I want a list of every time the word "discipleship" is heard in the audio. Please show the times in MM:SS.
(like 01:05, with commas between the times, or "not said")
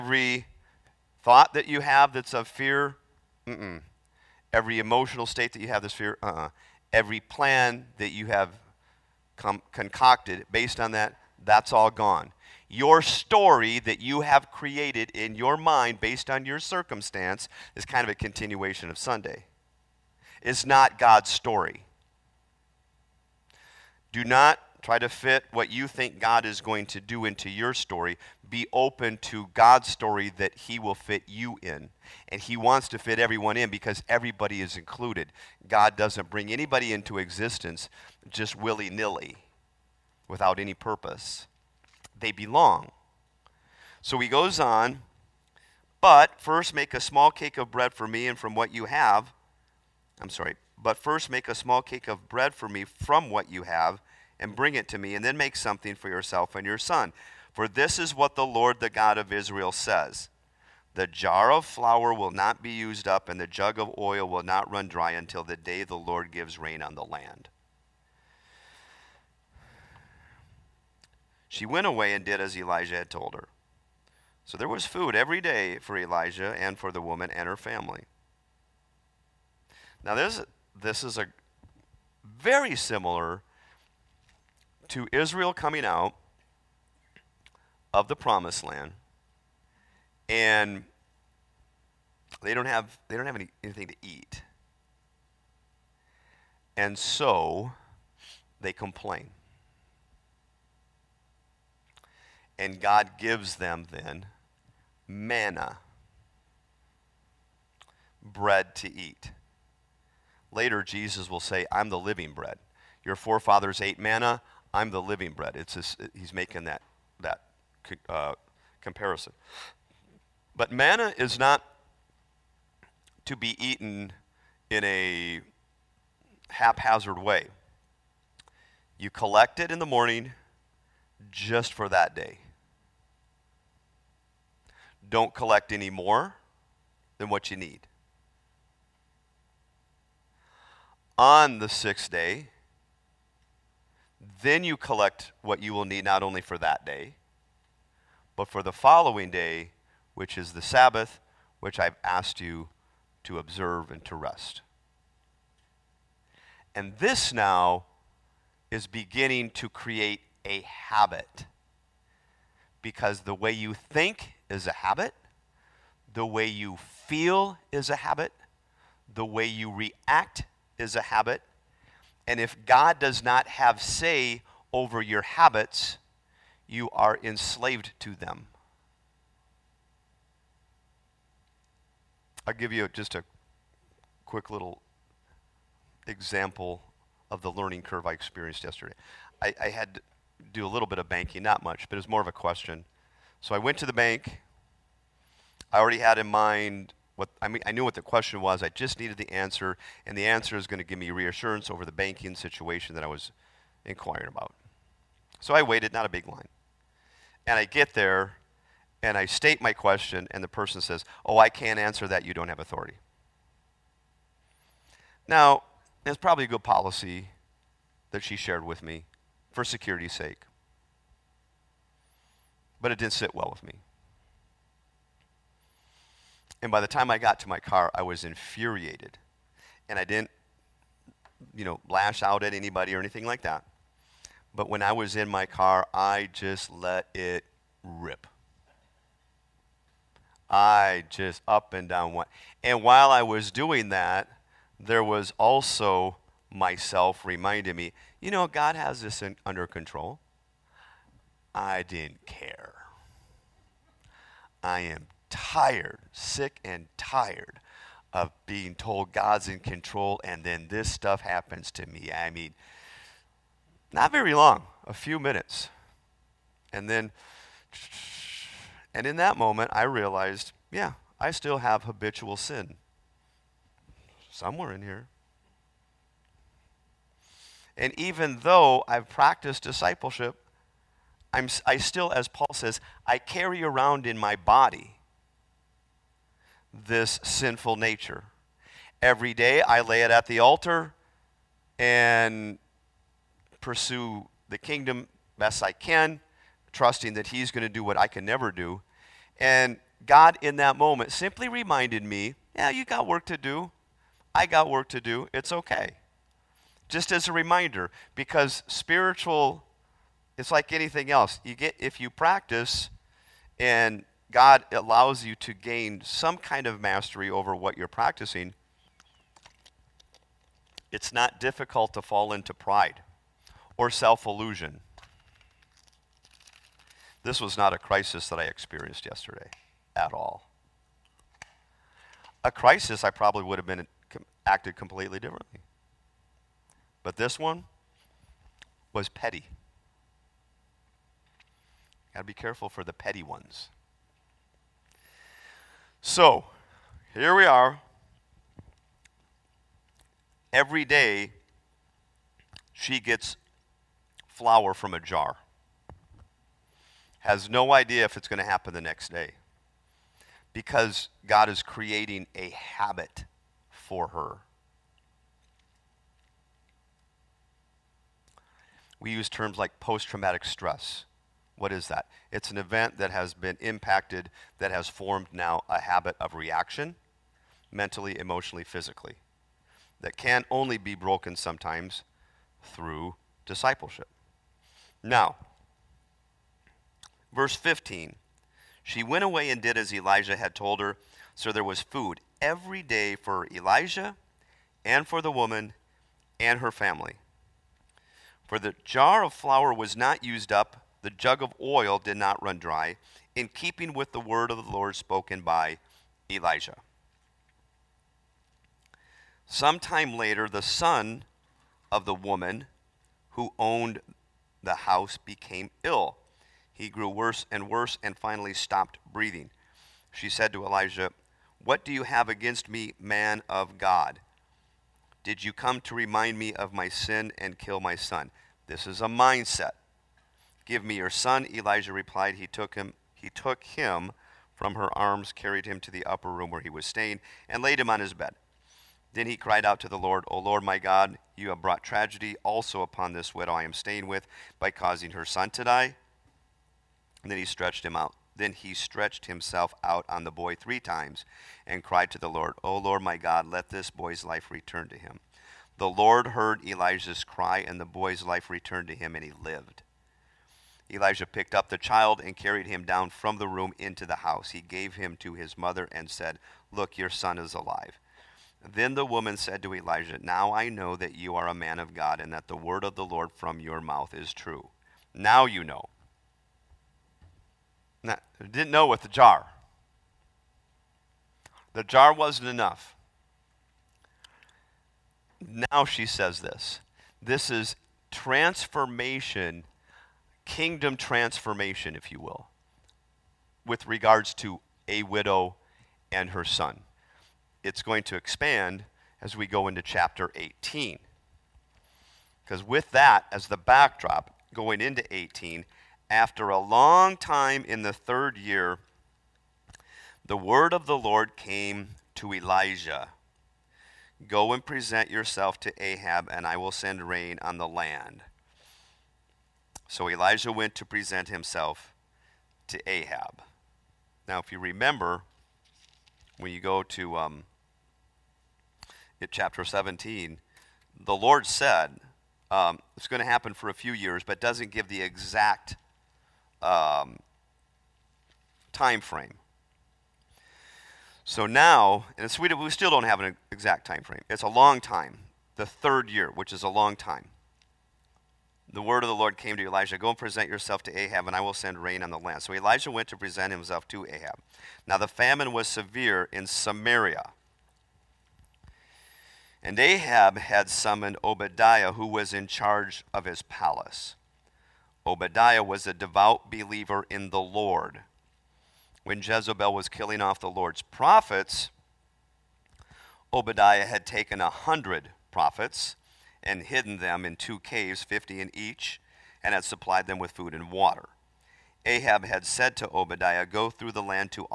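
04:39, 06:23.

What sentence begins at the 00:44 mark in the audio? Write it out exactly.
So he goes on, but first make a small cake of bread for me and from what you have.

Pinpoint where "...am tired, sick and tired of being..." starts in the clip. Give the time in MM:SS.
04:14.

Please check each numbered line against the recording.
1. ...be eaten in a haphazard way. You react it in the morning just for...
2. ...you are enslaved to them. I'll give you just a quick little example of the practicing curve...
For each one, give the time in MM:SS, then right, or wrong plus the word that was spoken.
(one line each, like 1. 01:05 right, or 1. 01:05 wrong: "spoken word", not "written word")
1. 02:03 wrong: "collect", not "react"
2. 02:56 wrong: "learning", not "practicing".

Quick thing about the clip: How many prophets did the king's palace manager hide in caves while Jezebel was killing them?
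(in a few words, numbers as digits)
100.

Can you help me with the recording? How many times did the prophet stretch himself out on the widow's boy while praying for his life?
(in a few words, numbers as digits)
3.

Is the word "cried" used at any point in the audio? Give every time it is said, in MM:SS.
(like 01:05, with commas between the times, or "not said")
07:19, 07:31.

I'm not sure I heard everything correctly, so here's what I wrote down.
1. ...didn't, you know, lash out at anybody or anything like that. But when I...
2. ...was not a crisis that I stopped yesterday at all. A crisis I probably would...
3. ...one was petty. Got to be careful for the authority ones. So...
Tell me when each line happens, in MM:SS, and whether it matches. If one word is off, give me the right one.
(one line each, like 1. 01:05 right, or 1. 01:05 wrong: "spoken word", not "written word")
1. 03:50 right
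2. 05:27 wrong: "experienced", not "stopped"
3. 05:37 wrong: "petty", not "authority".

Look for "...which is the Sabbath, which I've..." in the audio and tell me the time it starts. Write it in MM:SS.
02:30.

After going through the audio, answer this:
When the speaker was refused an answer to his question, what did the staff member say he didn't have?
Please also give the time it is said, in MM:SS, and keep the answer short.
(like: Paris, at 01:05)
authority, at 03:32.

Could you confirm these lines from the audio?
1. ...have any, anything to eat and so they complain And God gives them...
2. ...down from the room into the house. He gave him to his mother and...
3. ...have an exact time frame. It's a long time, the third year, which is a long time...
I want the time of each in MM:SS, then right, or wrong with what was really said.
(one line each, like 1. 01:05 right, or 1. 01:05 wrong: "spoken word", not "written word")
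1. 01:33 right
2. 07:42 right
3. 09:03 right.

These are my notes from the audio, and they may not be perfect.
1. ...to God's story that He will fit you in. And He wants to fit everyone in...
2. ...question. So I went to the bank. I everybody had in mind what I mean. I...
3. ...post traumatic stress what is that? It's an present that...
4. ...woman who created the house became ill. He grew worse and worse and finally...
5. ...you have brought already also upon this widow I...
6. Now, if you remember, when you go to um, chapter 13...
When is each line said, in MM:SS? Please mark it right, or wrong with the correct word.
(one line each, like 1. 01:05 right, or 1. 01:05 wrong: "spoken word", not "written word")
1. 00:29 right
2. 03:12 wrong: "already", not "everybody"
3. 06:09 wrong: "event", not "present"
4. 06:52 wrong: "owned", not "created"
5. 07:21 wrong: "tragedy", not "already"
6. 08:44 wrong: "17", not "13".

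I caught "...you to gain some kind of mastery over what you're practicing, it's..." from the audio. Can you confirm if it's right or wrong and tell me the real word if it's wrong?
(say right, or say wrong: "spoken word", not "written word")
right.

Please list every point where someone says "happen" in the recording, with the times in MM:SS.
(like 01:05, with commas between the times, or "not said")
04:21, 05:58, 08:53.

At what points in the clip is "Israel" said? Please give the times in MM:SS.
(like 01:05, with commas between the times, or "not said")
00:59, 01:25.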